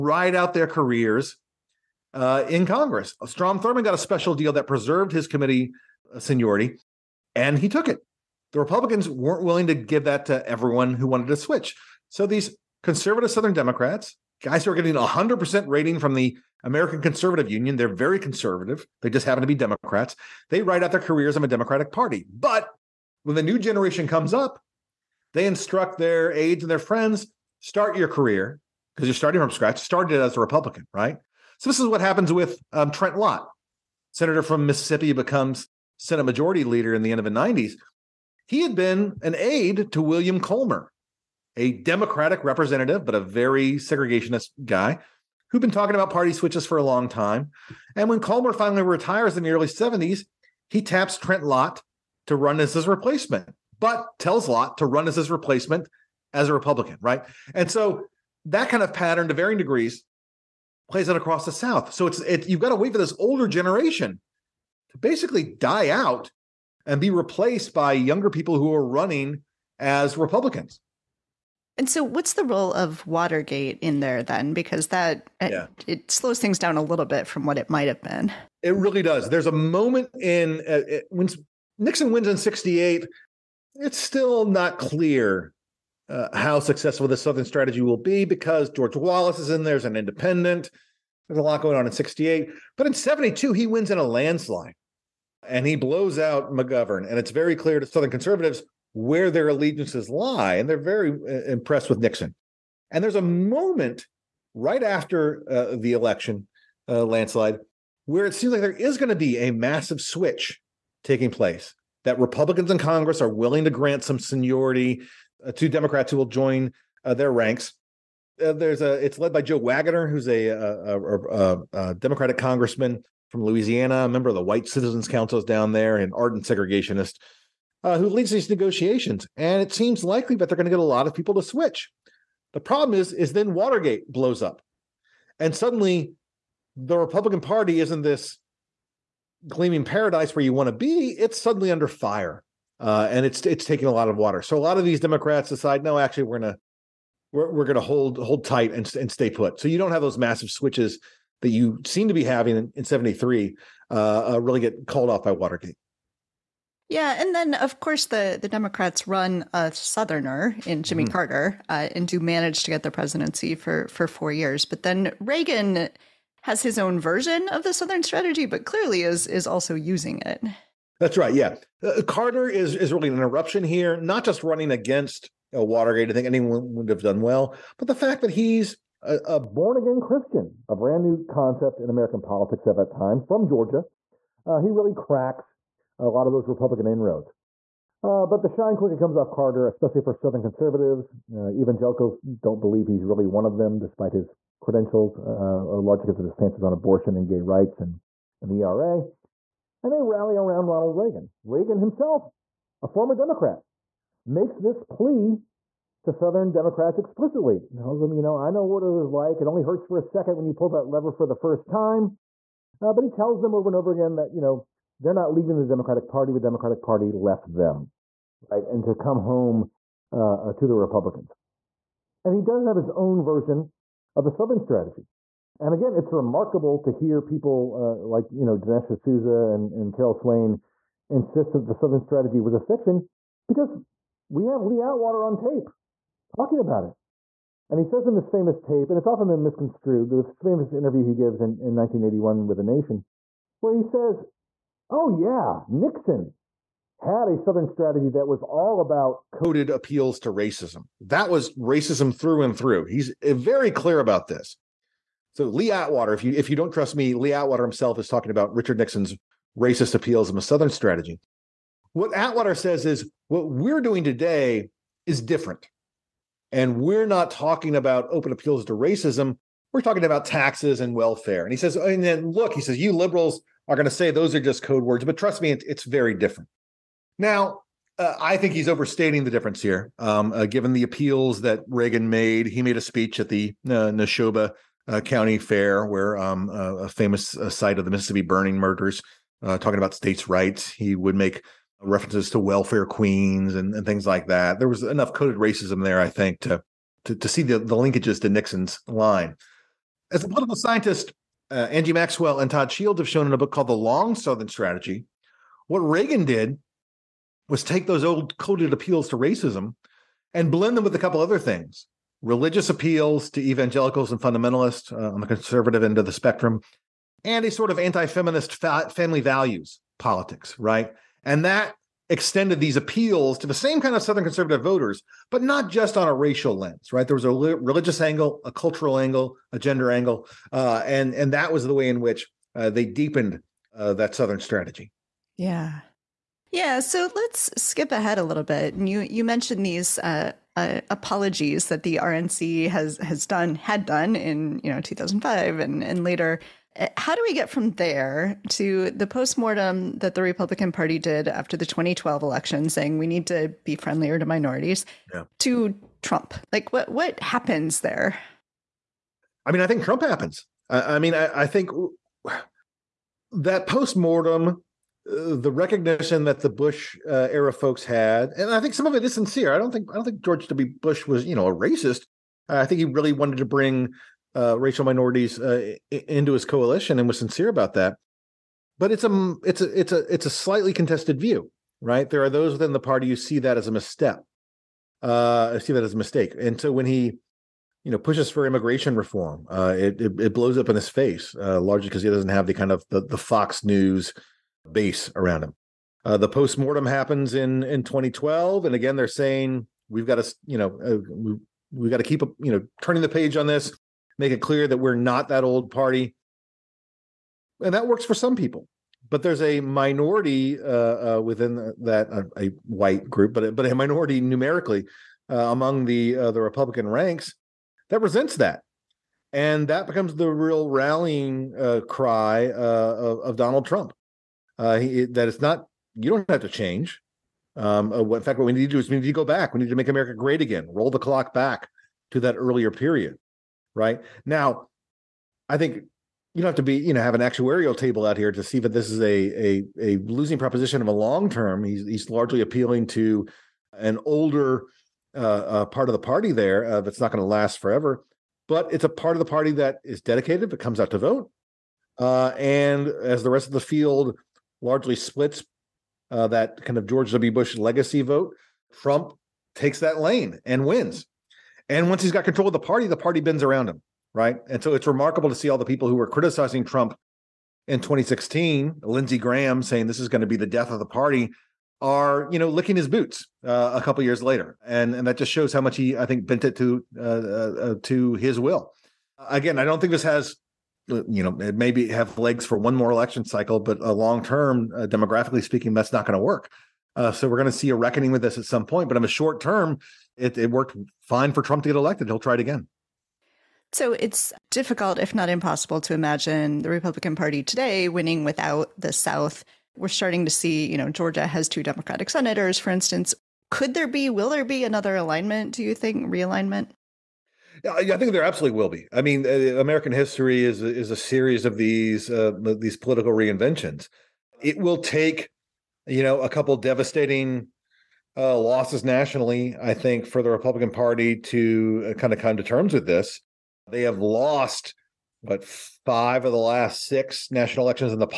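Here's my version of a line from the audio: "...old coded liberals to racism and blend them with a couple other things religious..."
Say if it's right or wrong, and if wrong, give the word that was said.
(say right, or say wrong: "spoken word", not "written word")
wrong: "appeals", not "liberals".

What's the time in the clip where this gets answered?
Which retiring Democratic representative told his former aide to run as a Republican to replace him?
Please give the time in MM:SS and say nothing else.
00:40.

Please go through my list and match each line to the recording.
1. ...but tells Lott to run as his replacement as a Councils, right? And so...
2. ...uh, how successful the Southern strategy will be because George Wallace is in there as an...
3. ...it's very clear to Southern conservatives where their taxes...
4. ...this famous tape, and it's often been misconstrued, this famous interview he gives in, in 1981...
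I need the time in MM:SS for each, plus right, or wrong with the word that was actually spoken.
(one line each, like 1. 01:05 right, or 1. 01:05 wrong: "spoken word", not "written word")
1. 00:53 wrong: "Republican", not "Councils"
2. 01:26 right
3. 01:37 wrong: "allegiances", not "taxes"
4. 03:58 right.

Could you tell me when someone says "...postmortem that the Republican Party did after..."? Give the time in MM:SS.
05:49.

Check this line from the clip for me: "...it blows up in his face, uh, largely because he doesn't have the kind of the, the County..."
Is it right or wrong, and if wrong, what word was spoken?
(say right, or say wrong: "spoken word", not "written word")
wrong: "Fox", not "County".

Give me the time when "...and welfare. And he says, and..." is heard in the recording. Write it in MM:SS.
04:30.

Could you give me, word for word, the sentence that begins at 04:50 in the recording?
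He would make references to welfare queens and, and things like that.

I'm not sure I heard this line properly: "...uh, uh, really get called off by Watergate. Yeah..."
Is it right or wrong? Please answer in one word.
right.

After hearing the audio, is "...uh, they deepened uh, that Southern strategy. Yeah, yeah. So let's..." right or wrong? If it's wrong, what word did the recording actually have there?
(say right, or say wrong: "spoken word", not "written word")
right.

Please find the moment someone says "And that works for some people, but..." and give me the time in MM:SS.
06:47.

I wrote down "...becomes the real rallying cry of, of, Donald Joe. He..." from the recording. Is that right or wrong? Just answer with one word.
wrong.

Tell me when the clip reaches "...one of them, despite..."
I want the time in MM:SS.
03:13.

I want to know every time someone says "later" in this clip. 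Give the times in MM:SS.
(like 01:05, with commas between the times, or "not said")
05:46, 07:54.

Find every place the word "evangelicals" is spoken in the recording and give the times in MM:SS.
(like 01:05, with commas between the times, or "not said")
03:11, 05:13.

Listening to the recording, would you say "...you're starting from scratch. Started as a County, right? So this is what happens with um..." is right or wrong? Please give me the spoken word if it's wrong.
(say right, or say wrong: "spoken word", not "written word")
wrong: "Republican", not "County".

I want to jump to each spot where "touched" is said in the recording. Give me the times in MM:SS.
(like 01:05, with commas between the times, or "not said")
not said.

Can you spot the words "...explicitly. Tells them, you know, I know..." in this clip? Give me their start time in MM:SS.
03:26.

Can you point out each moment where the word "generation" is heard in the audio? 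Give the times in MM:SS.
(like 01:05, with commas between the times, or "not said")
00:23, 01:03.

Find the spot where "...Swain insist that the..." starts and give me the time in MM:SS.
03:50.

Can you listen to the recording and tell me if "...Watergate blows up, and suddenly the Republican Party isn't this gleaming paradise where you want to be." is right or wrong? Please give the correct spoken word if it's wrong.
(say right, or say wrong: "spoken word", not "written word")
right.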